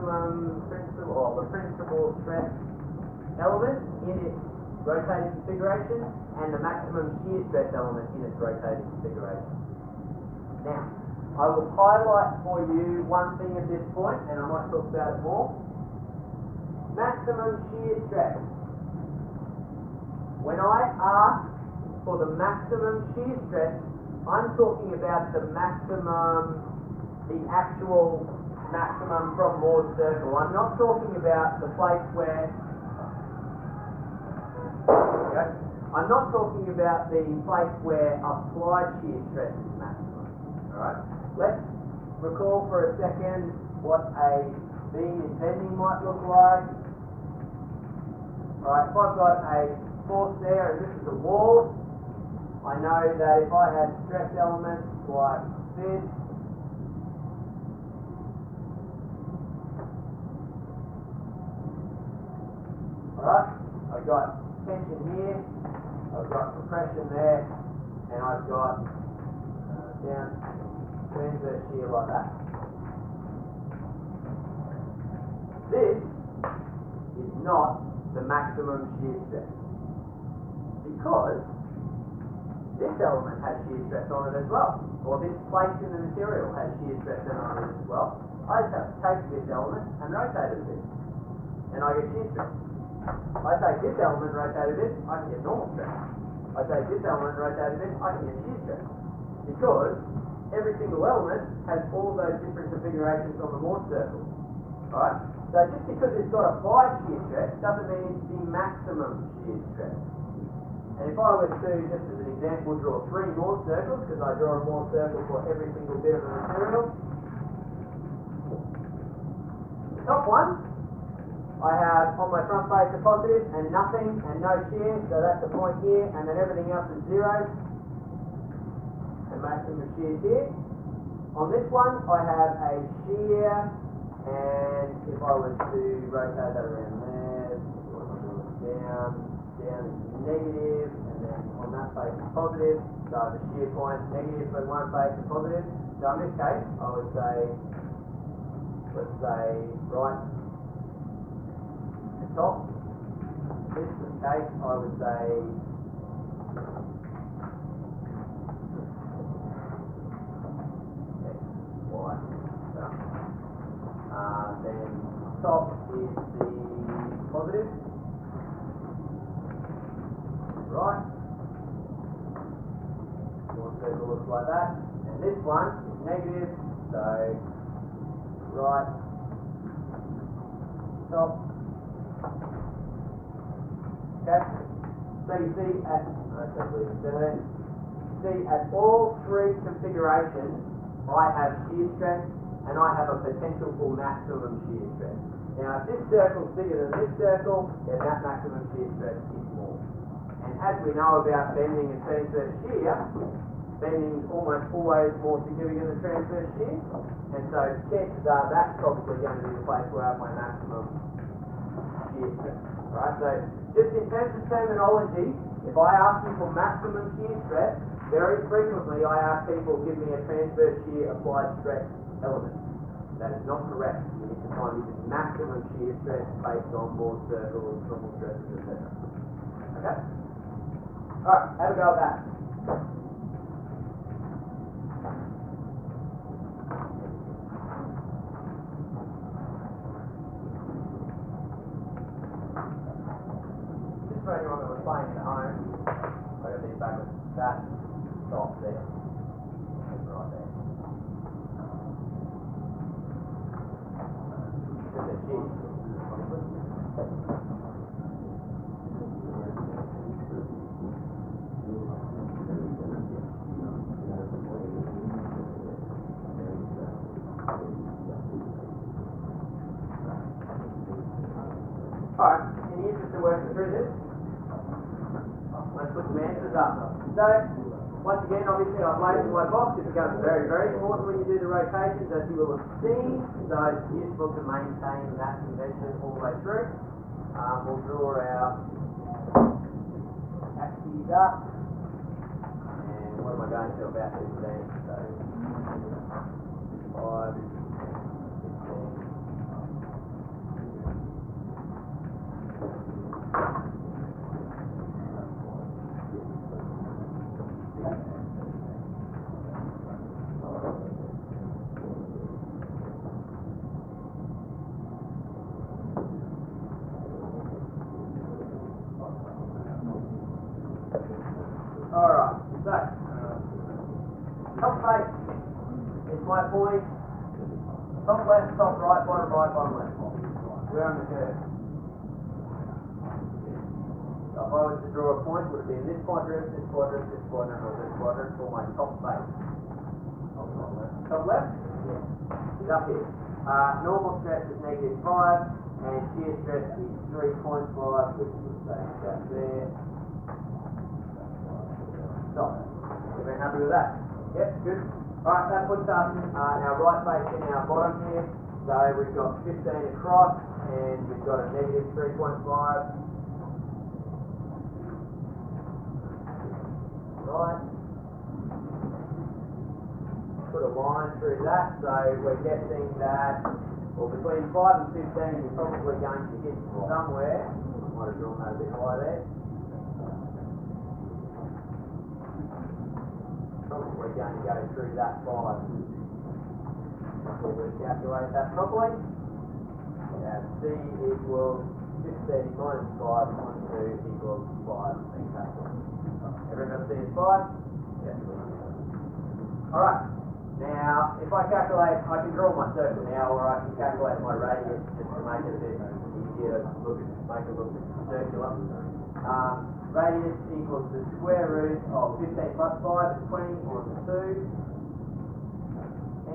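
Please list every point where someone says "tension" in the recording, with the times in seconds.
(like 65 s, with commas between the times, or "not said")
64 s.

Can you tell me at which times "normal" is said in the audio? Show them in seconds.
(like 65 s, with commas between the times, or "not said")
95 s, 227 s.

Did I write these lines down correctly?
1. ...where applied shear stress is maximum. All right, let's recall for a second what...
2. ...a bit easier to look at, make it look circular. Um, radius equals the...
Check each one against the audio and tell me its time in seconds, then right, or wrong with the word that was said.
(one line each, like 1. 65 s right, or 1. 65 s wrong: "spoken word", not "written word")
1. 37 s right
2. 405 s right.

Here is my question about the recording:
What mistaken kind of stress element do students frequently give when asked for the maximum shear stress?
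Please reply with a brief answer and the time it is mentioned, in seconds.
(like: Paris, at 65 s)
transverse shear applied stress element, at 220 s.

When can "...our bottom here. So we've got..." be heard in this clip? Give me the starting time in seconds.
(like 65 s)
357 s.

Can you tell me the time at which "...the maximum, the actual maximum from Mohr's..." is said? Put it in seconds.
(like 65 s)
25 s.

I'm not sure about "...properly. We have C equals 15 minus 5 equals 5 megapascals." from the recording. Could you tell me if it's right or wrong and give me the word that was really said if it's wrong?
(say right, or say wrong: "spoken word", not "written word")
right.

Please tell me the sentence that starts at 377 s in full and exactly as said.
Might have drawn that a bit higher there.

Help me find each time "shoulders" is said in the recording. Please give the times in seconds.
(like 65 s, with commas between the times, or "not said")
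not said.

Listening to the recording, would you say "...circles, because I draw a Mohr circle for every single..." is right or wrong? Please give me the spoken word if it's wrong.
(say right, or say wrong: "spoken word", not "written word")
right.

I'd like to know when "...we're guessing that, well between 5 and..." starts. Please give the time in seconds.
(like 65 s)
372 s.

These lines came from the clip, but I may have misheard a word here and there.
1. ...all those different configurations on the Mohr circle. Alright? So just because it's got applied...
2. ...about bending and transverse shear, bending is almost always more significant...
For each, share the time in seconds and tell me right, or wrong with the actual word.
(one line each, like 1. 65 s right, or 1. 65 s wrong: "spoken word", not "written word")
1. 101 s right
2. 201 s right.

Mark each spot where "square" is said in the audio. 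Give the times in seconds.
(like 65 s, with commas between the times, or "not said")
411 s.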